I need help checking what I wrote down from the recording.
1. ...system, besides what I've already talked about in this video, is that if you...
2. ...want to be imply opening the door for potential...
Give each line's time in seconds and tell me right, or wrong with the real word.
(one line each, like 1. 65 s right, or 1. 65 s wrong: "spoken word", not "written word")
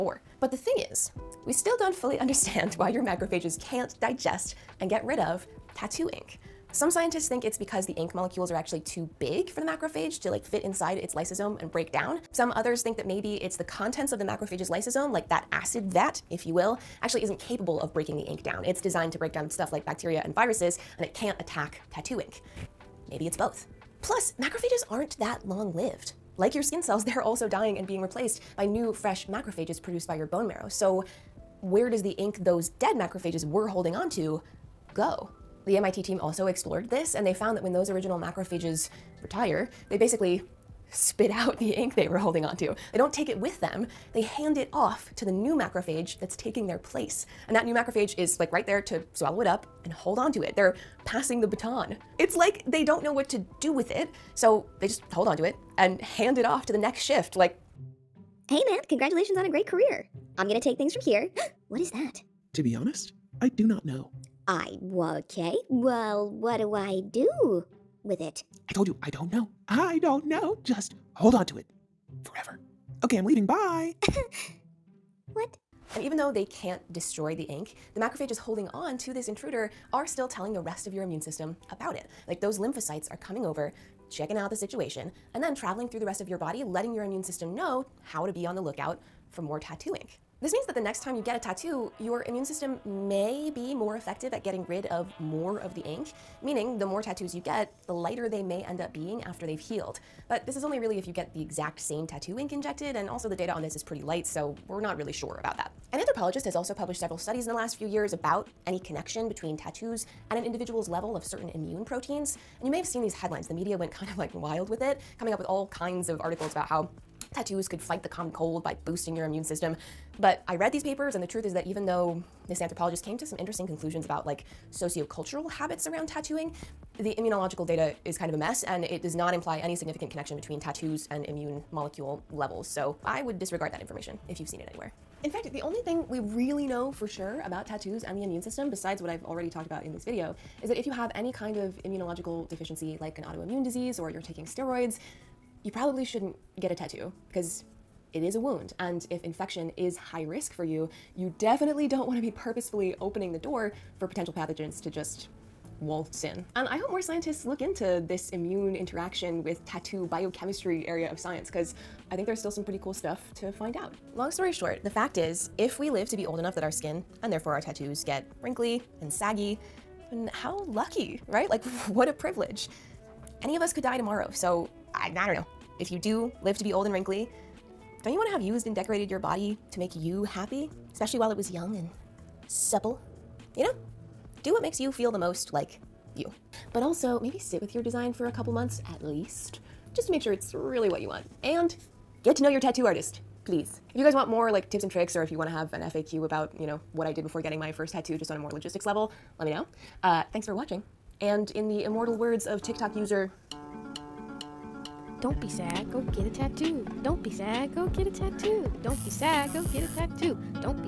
1. 138 s right
2. 152 s wrong: "purposefully", not "imply".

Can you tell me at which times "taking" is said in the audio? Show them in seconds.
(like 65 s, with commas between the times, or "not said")
46 s, 144 s.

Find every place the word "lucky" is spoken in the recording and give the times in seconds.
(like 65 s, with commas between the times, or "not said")
170 s.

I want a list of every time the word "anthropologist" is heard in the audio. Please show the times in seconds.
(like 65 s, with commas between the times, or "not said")
105 s, 122 s.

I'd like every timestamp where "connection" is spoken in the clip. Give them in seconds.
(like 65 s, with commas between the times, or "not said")
108 s, 130 s.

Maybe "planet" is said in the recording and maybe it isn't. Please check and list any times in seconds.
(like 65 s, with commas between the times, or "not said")
not said.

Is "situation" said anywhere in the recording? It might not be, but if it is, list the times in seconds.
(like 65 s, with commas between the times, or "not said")
84 s.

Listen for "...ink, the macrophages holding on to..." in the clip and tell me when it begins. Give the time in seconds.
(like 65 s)
77 s.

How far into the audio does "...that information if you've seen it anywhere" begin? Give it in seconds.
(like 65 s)
133 s.